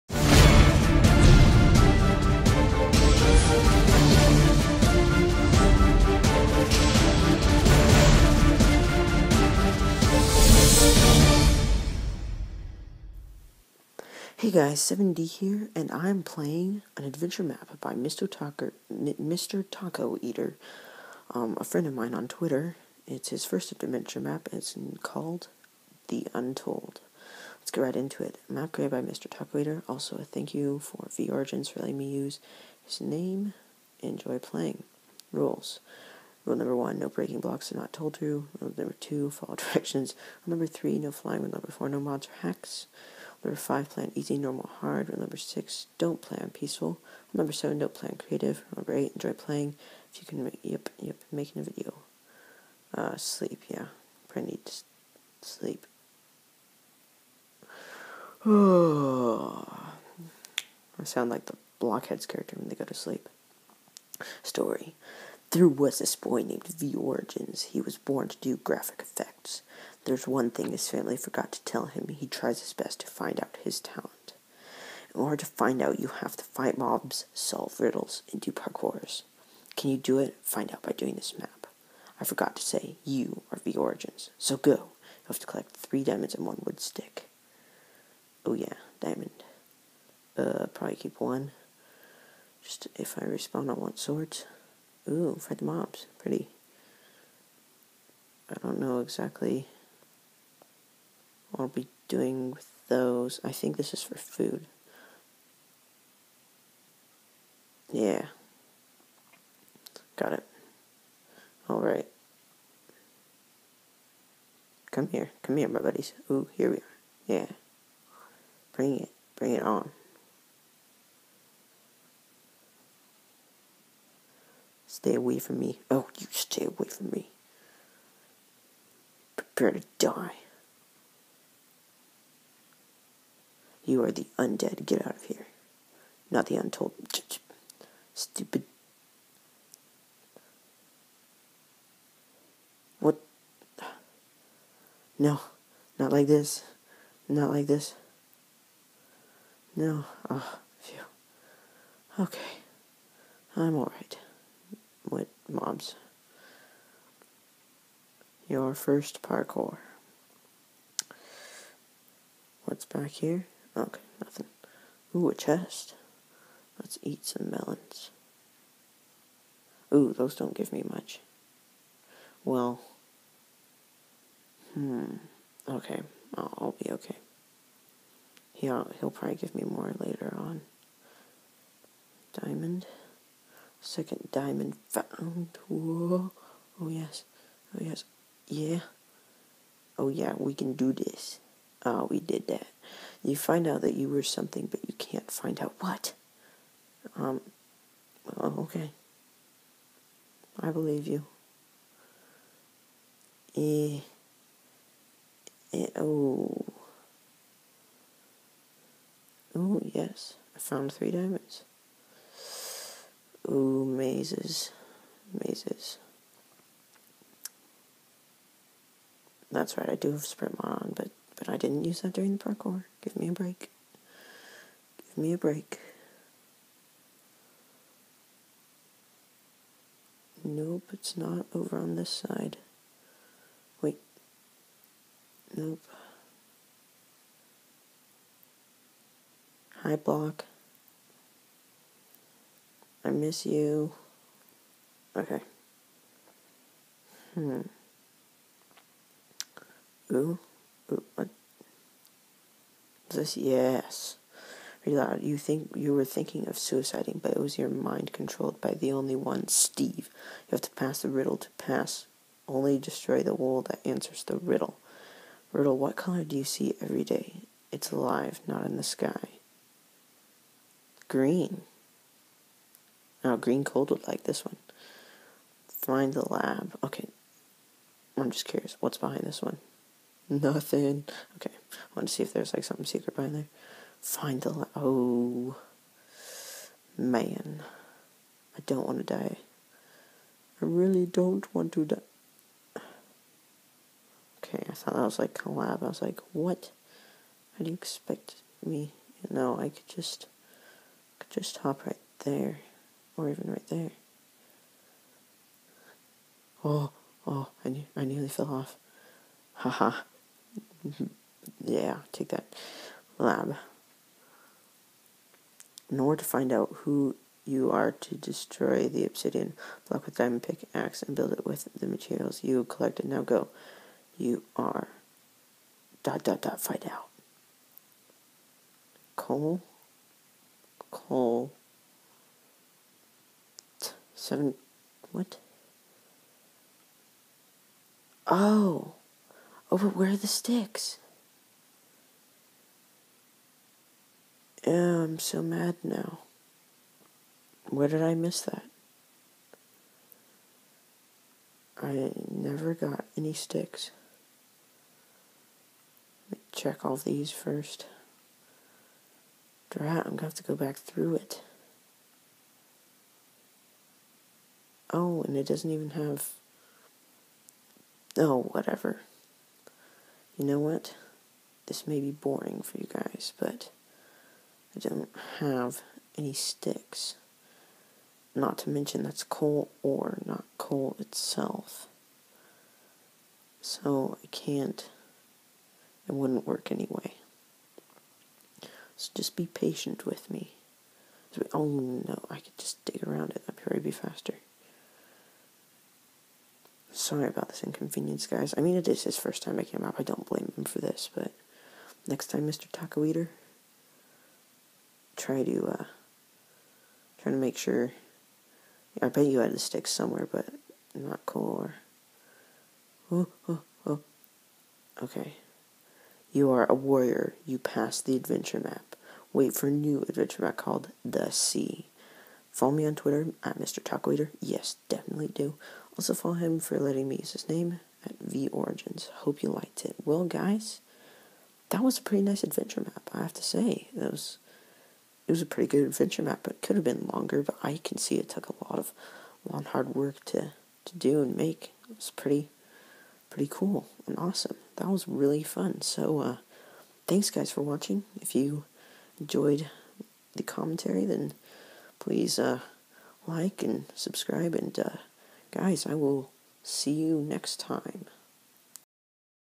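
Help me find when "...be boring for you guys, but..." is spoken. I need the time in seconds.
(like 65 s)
372 s.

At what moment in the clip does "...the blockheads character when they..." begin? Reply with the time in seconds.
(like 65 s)
61 s.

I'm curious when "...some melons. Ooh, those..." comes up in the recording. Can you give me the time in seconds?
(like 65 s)
167 s.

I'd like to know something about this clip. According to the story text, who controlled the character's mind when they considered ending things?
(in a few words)
Steve.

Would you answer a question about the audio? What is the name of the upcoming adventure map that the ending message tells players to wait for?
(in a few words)
The Sea.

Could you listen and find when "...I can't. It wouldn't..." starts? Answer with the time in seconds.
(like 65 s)
384 s.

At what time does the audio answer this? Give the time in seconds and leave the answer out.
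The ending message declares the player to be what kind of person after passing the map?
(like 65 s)
416 s.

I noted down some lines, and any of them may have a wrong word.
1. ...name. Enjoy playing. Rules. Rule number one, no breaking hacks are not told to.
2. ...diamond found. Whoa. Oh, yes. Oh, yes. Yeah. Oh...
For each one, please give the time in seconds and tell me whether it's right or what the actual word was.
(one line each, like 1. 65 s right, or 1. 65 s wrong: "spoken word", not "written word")
1. 32 s wrong: "blocks", not "hacks"
2. 184 s right.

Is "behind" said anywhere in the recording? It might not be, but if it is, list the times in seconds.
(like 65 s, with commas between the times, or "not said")
278 s, 283 s.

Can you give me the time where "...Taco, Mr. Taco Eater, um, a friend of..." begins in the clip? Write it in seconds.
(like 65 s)
18 s.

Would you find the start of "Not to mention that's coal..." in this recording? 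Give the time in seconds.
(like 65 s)
378 s.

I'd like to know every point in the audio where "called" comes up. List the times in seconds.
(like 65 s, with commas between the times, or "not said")
25 s, 420 s.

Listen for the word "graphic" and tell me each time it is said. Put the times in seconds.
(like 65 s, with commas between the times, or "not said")
68 s.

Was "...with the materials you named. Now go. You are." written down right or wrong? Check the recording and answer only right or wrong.
wrong.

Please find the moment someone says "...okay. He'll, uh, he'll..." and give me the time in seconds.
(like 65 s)
176 s.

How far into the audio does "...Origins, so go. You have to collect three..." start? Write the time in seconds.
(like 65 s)
83 s.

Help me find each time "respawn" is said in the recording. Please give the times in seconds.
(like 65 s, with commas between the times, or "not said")
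93 s.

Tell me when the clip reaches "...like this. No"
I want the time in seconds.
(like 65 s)
147 s.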